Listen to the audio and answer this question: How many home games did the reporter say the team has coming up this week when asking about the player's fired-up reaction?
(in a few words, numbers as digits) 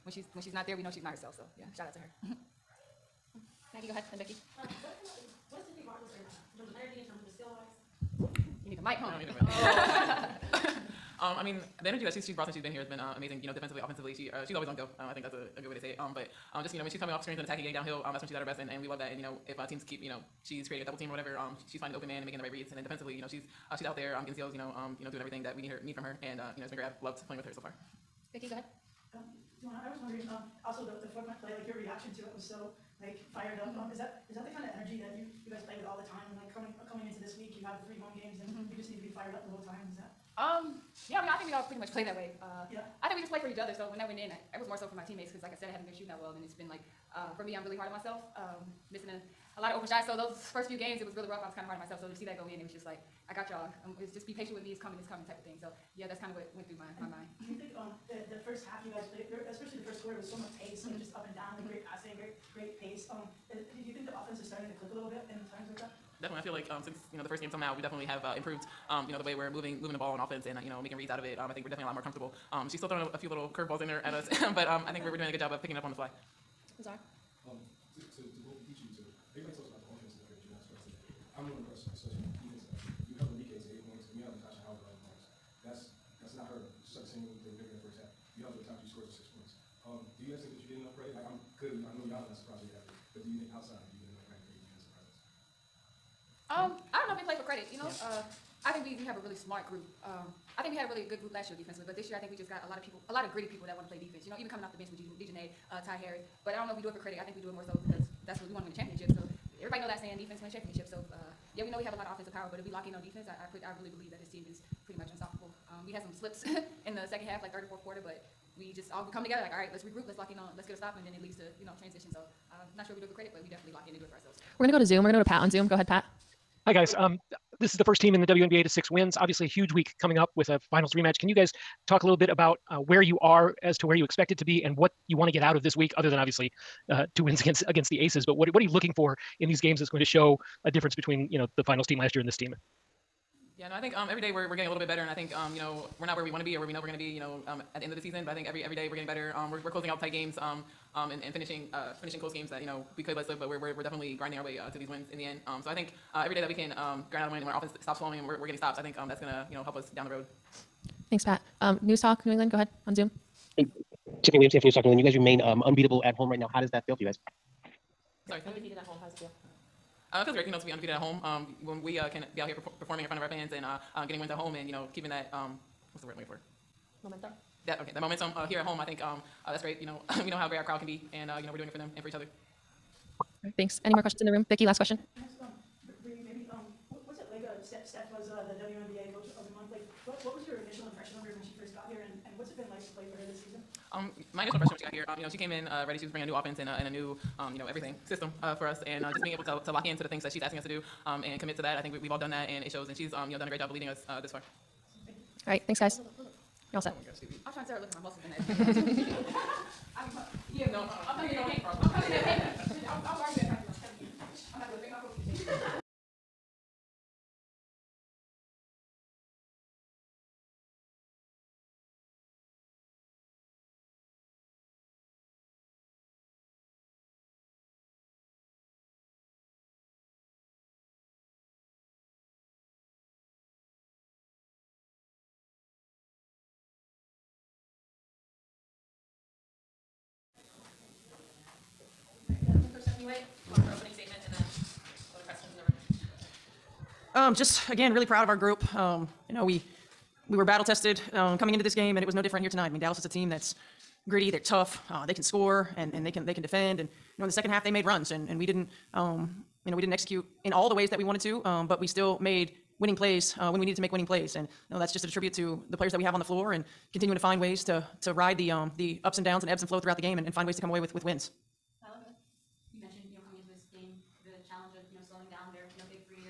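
3.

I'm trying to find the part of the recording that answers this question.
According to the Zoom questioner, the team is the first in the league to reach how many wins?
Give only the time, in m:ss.
2:08.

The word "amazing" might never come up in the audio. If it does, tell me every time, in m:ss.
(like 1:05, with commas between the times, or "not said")
0:13.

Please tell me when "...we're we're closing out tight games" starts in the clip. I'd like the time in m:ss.
2:29.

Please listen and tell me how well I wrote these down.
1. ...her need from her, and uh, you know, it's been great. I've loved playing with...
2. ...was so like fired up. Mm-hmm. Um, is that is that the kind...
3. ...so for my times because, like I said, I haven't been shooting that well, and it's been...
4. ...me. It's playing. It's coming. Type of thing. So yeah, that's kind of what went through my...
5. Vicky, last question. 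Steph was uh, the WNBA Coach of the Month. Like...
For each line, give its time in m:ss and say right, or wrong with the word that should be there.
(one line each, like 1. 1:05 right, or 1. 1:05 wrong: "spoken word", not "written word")
1. 0:25 right
2. 0:32 right
3. 0:44 wrong: "teammates", not "times"
4. 0:54 wrong: "coming", not "playing"
5. 3:04 right.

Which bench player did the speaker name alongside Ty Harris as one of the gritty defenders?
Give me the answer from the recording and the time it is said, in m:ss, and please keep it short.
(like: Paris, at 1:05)
DiJonai, at 1:44.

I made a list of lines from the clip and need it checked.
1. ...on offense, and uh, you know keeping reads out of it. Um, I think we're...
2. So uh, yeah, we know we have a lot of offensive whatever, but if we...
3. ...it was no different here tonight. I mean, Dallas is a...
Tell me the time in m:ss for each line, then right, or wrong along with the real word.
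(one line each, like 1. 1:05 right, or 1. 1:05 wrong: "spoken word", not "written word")
1. 1:10 wrong: "making", not "keeping"
2. 1:50 wrong: "power", not "whatever"
3. 4:12 right.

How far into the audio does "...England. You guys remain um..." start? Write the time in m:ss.
2:44.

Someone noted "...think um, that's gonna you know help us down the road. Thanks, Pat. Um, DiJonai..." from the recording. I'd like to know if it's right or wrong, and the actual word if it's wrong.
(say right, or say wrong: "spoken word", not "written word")
wrong: "News", not "DiJonai".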